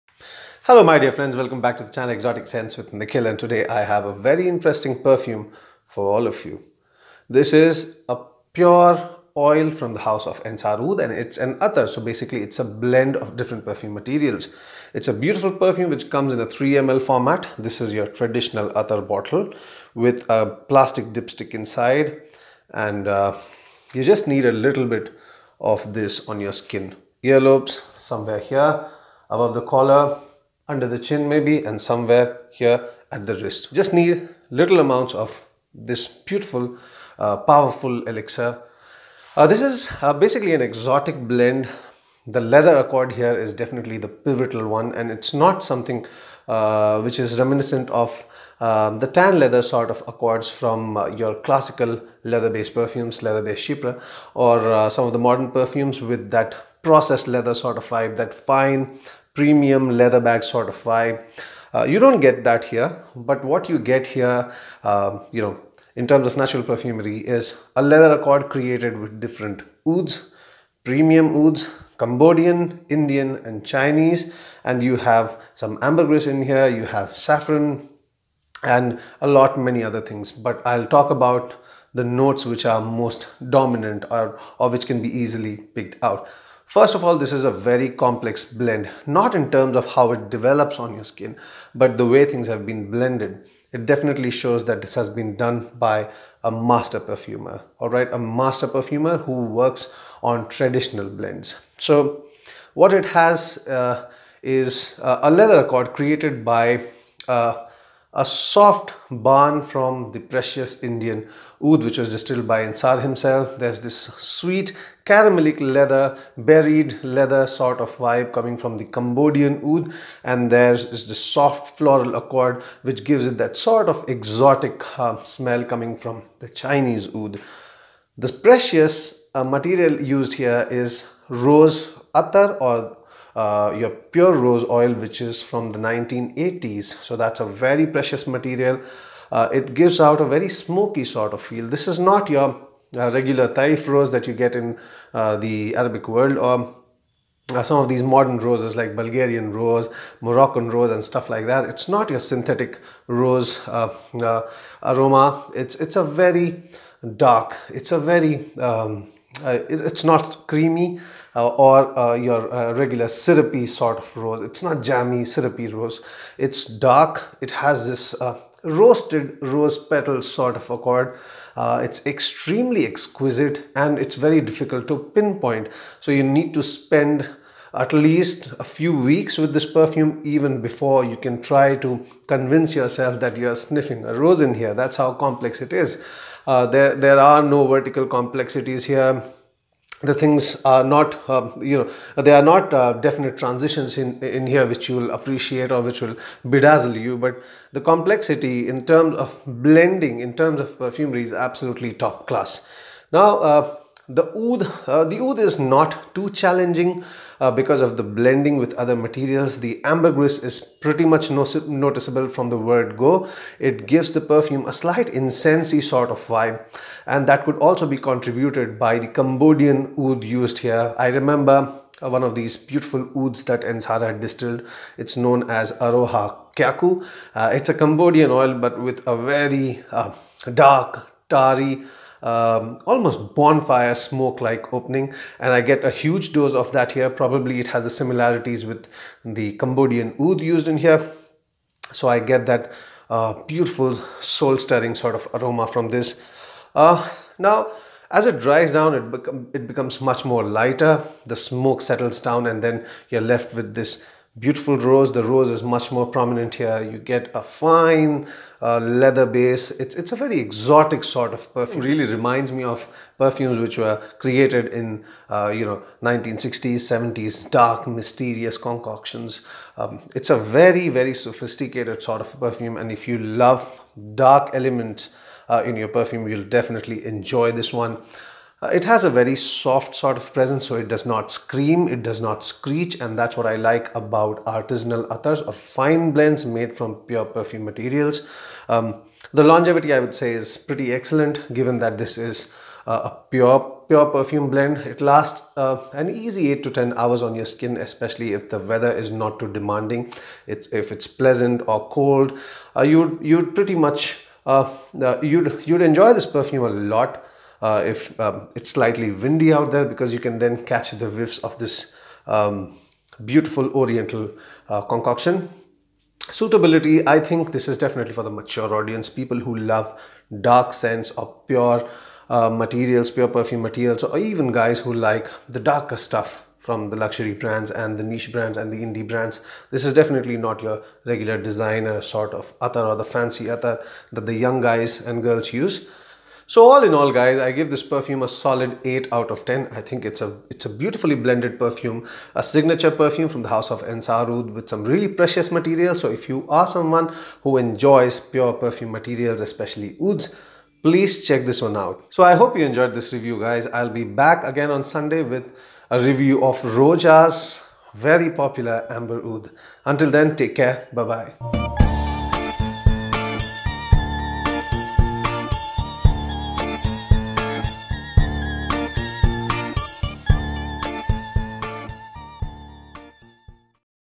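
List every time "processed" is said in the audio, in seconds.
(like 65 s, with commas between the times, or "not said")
56 s.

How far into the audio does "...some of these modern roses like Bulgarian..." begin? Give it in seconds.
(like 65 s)
147 s.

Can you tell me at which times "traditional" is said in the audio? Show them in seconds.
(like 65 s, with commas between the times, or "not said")
18 s, 100 s.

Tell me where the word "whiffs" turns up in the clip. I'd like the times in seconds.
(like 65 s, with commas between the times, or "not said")
311 s.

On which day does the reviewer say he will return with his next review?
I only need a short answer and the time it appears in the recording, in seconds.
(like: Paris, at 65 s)
Sunday, at 354 s.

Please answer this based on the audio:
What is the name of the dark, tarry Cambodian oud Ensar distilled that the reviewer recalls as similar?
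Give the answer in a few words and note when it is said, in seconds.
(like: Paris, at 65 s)
Aroha Kyaku, at 225 s.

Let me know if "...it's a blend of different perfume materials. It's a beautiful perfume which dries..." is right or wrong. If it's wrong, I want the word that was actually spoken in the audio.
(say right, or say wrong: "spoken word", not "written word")
wrong: "comes", not "dries".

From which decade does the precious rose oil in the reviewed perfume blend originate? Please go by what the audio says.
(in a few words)
1980s.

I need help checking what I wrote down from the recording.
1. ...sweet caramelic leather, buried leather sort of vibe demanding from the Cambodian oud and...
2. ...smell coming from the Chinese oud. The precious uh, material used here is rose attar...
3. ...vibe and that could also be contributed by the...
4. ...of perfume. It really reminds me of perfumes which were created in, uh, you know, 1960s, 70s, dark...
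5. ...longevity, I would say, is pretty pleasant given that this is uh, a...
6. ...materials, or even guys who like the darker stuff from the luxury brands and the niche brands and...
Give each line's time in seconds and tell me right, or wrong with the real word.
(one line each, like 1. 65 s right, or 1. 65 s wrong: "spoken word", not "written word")
1. 114 s wrong: "coming", not "demanding"
2. 125 s right
3. 216 s right
4. 261 s right
5. 289 s wrong: "excellent", not "pleasant"
6. 323 s right.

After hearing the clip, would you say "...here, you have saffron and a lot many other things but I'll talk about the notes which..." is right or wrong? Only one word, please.
right.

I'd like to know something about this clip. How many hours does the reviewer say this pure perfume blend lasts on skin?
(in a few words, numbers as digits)
8 to 10 hours.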